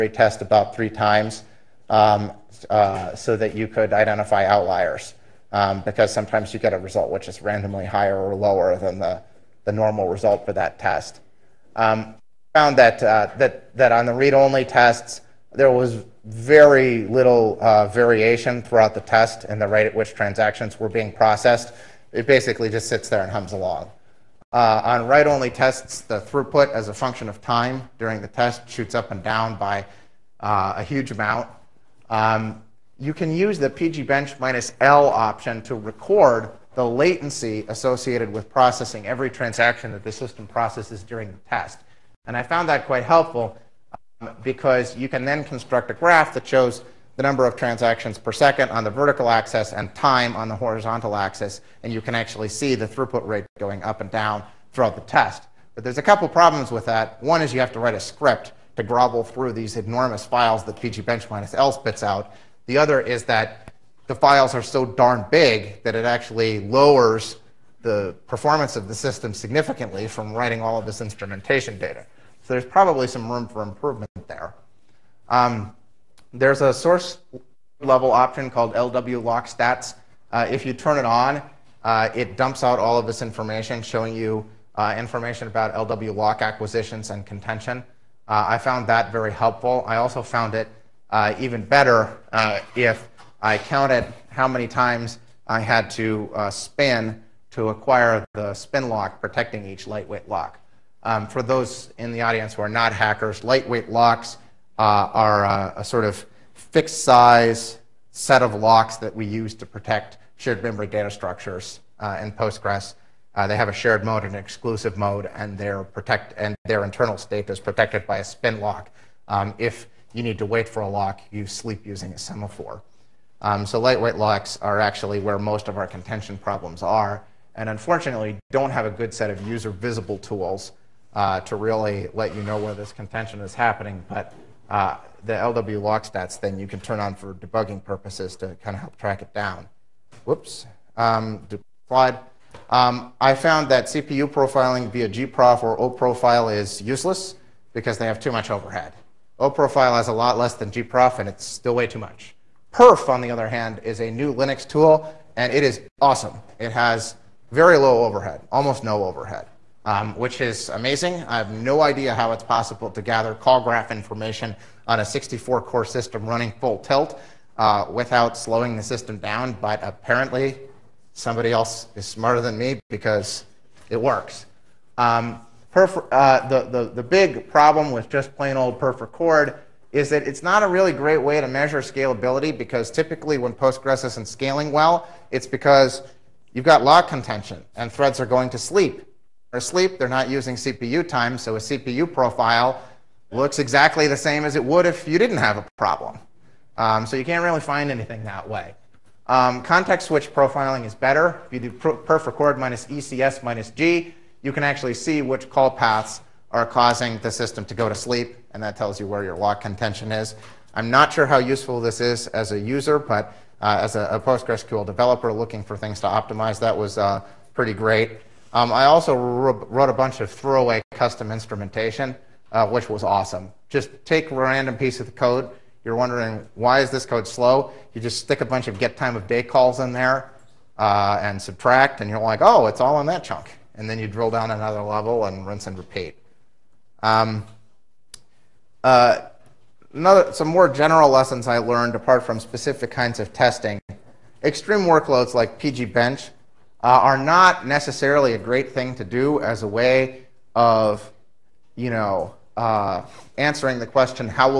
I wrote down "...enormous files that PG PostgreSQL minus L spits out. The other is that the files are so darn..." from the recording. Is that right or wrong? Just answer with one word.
wrong.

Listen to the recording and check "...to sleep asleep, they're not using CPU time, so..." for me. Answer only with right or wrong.
right.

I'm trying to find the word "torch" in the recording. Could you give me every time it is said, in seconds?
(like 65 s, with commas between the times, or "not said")
not said.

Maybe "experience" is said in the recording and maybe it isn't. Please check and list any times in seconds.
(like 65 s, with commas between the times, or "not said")
not said.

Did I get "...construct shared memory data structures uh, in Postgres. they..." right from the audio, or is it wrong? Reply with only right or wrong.
wrong.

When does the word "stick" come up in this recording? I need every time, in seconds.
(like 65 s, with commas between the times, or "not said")
228 s.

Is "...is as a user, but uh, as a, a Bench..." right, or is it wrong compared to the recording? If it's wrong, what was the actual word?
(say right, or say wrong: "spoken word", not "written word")
wrong: "PostgreSQL", not "Bench".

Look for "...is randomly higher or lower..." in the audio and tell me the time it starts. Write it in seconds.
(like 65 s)
7 s.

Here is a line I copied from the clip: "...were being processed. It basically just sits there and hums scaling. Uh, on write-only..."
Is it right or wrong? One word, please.
wrong.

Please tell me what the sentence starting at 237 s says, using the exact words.
Um, uh, another, some more general lessons I learned apart from specific kinds of testing.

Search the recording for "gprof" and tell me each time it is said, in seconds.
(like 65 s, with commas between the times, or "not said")
145 s, 150 s.